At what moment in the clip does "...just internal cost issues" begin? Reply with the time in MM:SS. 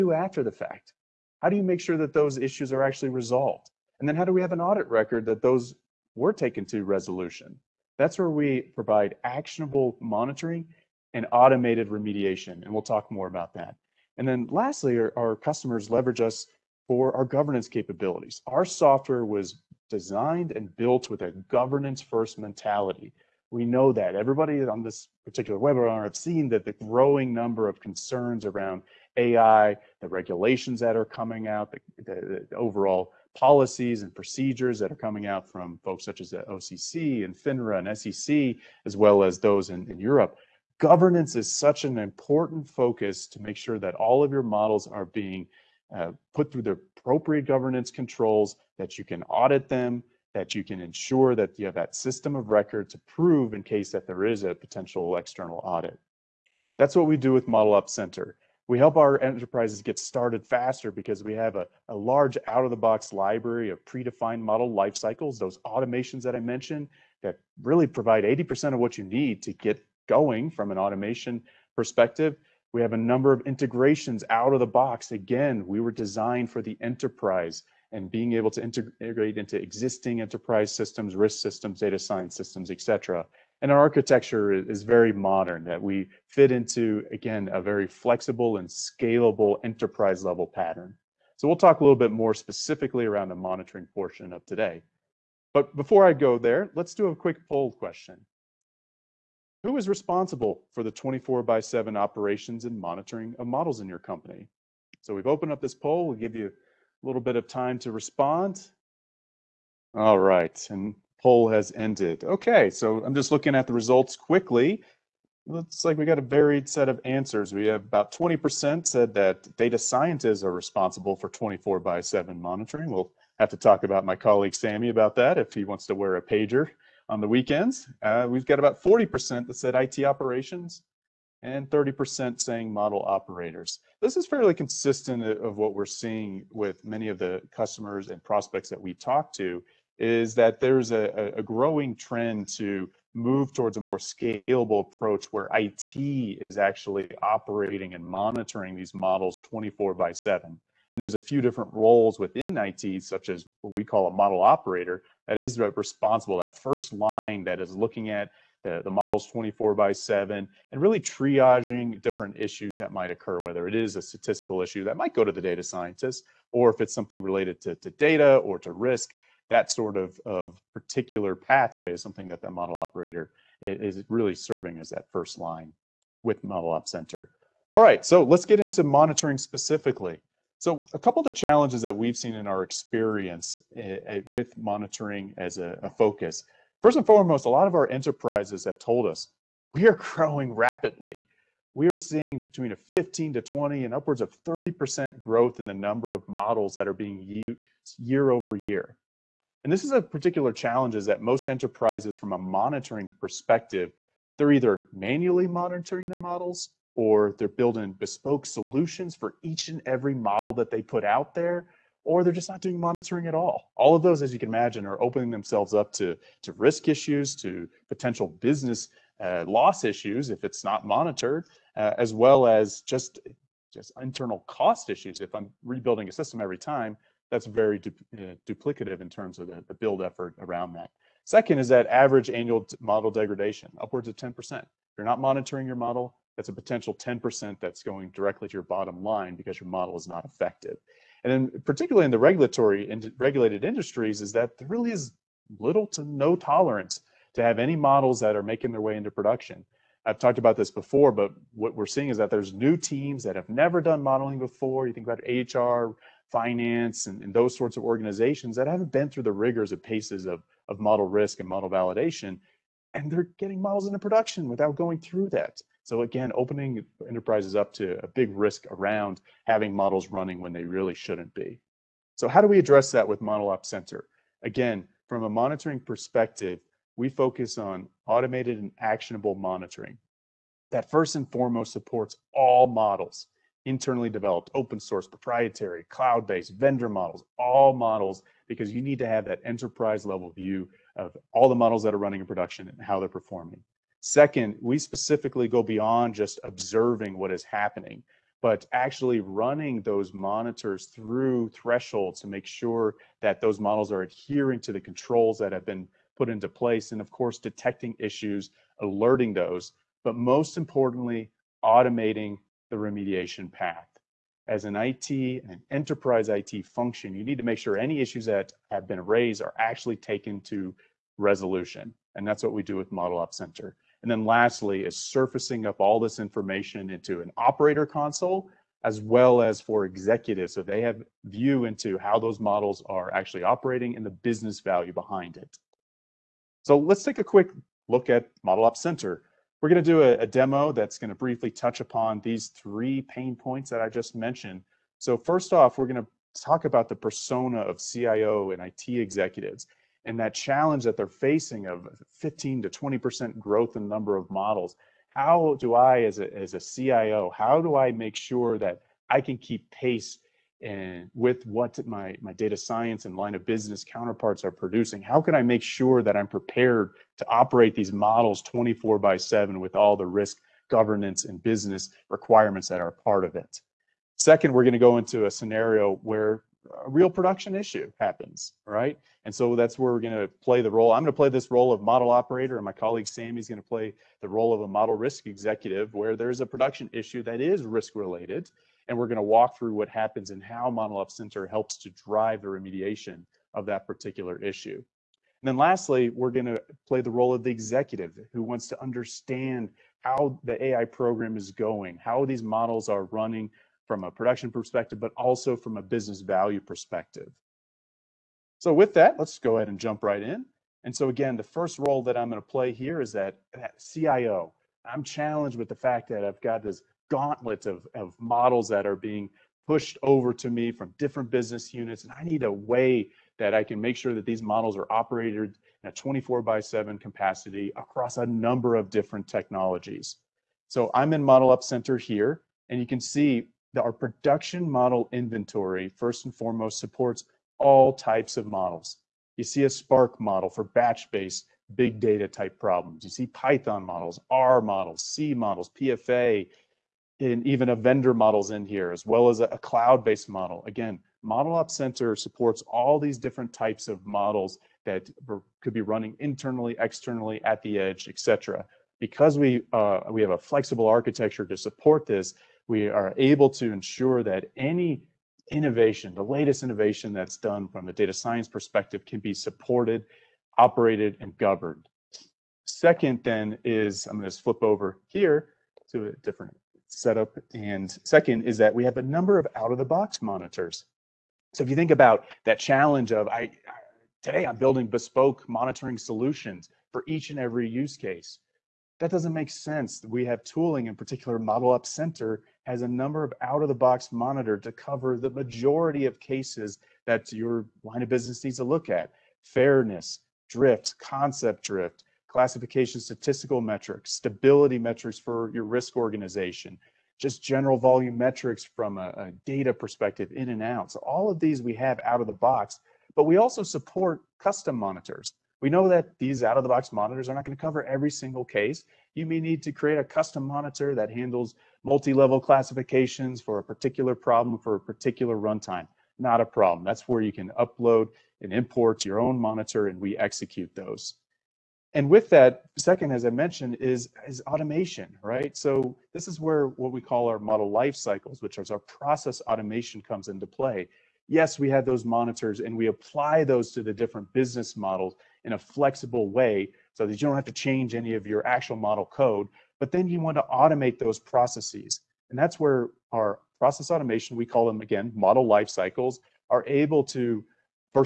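03:43.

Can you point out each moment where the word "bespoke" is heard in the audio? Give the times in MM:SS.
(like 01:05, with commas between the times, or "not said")
03:27, 08:04.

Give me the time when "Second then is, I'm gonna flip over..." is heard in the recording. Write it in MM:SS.
07:52.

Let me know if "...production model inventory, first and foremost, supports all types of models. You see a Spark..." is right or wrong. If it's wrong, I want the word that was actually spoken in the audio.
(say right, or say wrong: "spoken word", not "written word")
right.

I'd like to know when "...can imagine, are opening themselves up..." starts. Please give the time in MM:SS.
03:34.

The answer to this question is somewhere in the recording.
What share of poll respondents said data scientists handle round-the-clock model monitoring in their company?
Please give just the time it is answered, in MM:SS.
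01:57.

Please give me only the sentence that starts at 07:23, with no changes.
You see Python models, R models, C models, PFA, and even a vendor model's in here, as well as a, cloud-based model.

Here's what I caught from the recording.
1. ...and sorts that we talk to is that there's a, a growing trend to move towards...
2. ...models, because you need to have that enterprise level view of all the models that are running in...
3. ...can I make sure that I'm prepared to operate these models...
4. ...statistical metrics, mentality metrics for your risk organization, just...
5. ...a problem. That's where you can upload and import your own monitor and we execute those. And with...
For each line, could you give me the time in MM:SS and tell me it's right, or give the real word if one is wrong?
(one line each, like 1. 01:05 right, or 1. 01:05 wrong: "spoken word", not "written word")
1. 02:18 wrong: "prospects", not "sorts"
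2. 04:47 right
3. 06:05 right
4. 08:23 wrong: "stability", not "mentality"
5. 08:46 right.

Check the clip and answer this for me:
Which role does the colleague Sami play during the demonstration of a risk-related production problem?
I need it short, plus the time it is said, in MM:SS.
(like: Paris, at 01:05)
model risk executive, at 06:24.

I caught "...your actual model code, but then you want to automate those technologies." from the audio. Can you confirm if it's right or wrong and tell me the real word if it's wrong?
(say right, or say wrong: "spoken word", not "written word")
wrong: "processes", not "technologies".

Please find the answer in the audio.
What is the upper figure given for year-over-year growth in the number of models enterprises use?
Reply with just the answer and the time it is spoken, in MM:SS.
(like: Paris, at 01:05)
30%, at 03:13.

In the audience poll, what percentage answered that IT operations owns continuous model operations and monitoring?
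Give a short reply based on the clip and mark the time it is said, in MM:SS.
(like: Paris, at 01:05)
40%, at 02:08.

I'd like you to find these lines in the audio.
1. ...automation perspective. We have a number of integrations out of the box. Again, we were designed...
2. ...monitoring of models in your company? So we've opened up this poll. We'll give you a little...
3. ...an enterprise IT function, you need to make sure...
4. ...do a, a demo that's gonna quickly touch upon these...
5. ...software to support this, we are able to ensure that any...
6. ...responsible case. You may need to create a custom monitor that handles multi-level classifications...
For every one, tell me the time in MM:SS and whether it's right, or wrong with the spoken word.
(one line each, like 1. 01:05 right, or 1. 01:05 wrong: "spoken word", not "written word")
1. 01:10 right
2. 01:42 right
3. 05:15 right
4. 05:39 wrong: "briefly", not "quickly"
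5. 07:40 wrong: "architecture", not "software"
6. 08:38 wrong: "single", not "responsible".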